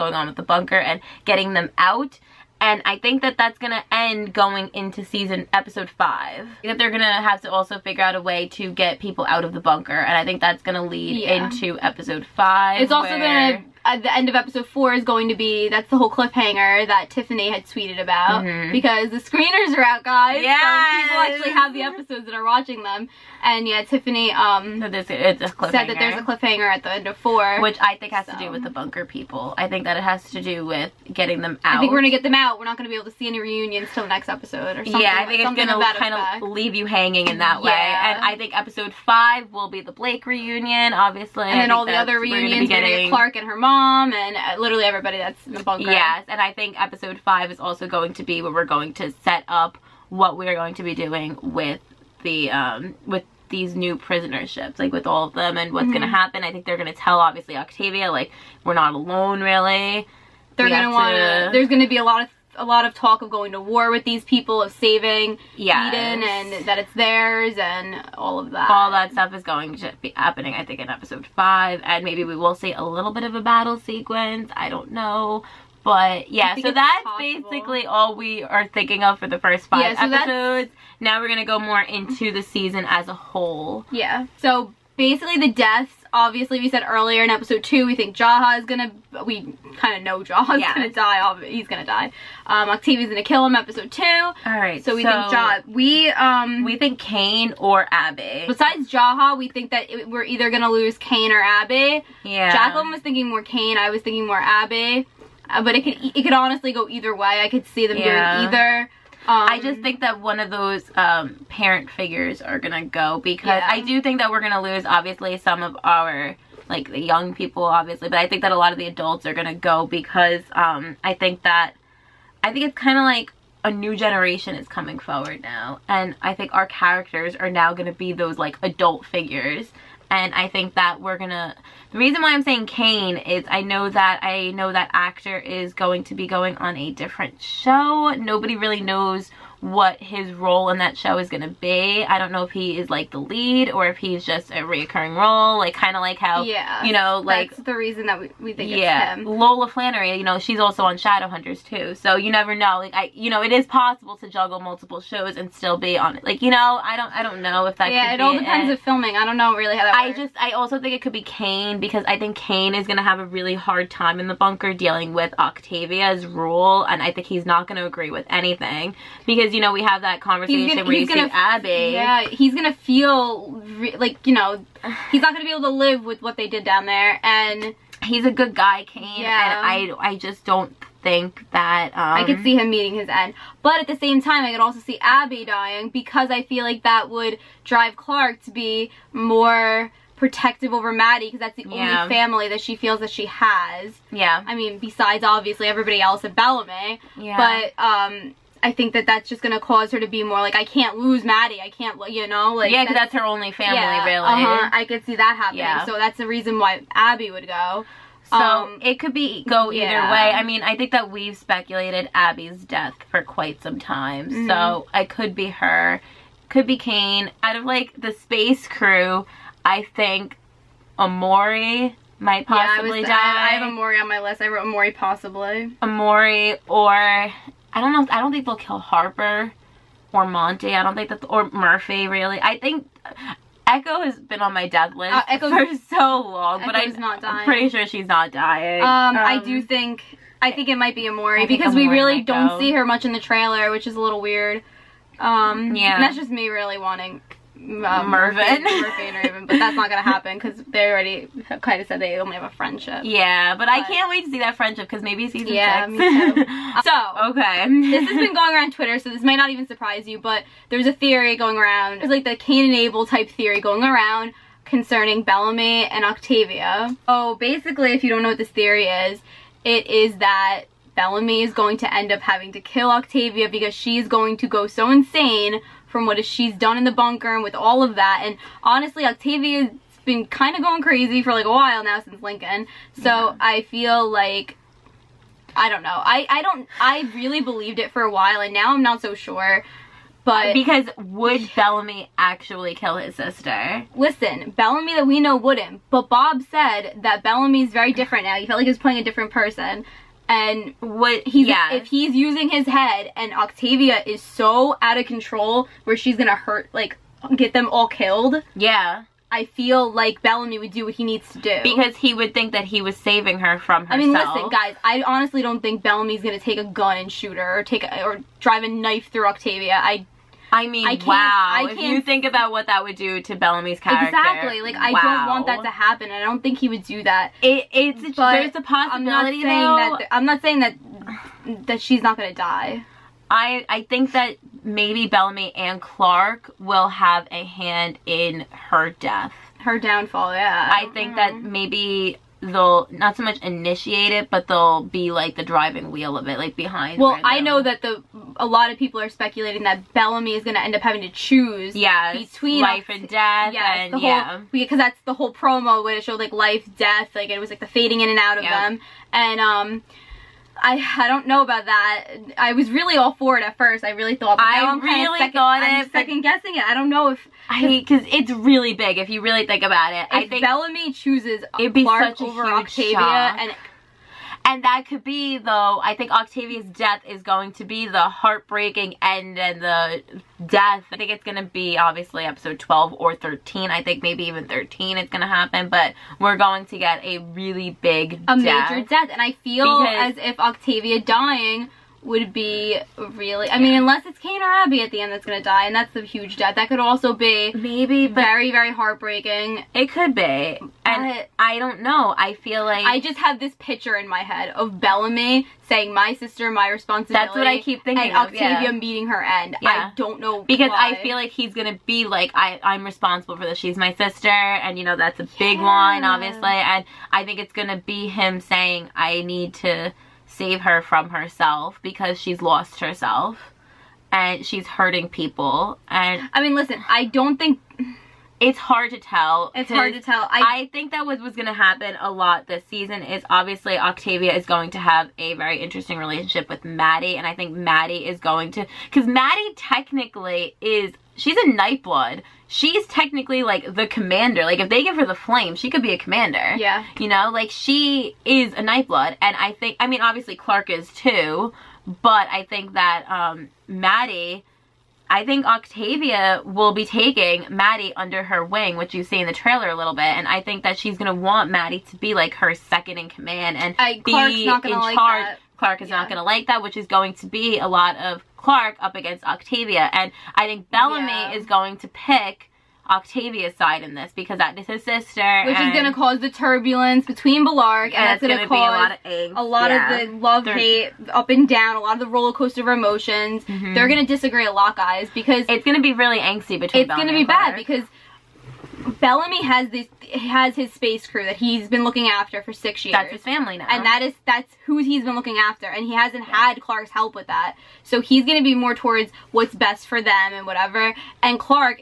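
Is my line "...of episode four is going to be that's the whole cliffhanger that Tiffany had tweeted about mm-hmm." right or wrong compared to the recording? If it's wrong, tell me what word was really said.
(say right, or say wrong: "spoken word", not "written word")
right.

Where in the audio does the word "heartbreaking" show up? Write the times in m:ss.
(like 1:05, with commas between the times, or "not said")
6:18, 6:38.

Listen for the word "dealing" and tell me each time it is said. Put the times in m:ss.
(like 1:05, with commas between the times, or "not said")
2:44.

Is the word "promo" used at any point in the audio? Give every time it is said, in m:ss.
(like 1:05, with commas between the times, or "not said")
5:55.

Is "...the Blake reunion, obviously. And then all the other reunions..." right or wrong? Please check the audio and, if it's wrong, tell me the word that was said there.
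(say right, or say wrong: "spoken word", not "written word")
right.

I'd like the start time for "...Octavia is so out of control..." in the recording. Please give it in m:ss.
5:03.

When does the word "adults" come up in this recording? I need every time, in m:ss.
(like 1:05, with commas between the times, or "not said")
1:58, 2:08.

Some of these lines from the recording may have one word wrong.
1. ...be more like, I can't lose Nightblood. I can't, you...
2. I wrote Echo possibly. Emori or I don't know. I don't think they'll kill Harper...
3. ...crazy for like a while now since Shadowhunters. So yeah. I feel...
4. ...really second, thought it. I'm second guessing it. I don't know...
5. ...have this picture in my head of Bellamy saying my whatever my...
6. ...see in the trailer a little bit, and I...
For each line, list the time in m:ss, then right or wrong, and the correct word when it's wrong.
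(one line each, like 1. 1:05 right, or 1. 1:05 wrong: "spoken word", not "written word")
1. 3:20 wrong: "Madi", not "Nightblood"
2. 3:44 wrong: "Emori", not "Echo"
3. 4:40 wrong: "Lincoln", not "Shadowhunters"
4. 6:04 right
5. 6:43 wrong: "sister", not "whatever"
6. 7:39 right.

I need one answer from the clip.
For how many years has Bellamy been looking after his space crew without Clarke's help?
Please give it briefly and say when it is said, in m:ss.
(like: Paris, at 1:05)
6, at 8:12.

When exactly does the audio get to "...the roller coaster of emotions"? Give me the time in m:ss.
8:02.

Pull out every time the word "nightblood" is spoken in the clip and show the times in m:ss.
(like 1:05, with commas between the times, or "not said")
7:21, 7:28.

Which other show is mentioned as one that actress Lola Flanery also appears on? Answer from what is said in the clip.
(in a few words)
Shadowhunters.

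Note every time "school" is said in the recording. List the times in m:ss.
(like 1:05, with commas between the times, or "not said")
not said.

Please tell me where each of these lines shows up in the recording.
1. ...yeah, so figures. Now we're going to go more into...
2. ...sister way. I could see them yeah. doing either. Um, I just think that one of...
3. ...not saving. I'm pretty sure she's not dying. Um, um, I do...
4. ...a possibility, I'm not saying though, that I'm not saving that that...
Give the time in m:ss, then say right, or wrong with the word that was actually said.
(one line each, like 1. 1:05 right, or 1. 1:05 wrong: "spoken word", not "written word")
1. 1:19 wrong: "episodes", not "figures"
2. 1:46 wrong: "either", not "sister"
3. 3:57 wrong: "dying", not "saving"
4. 5:28 wrong: "saying", not "saving".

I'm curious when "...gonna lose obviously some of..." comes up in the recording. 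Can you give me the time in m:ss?
1:54.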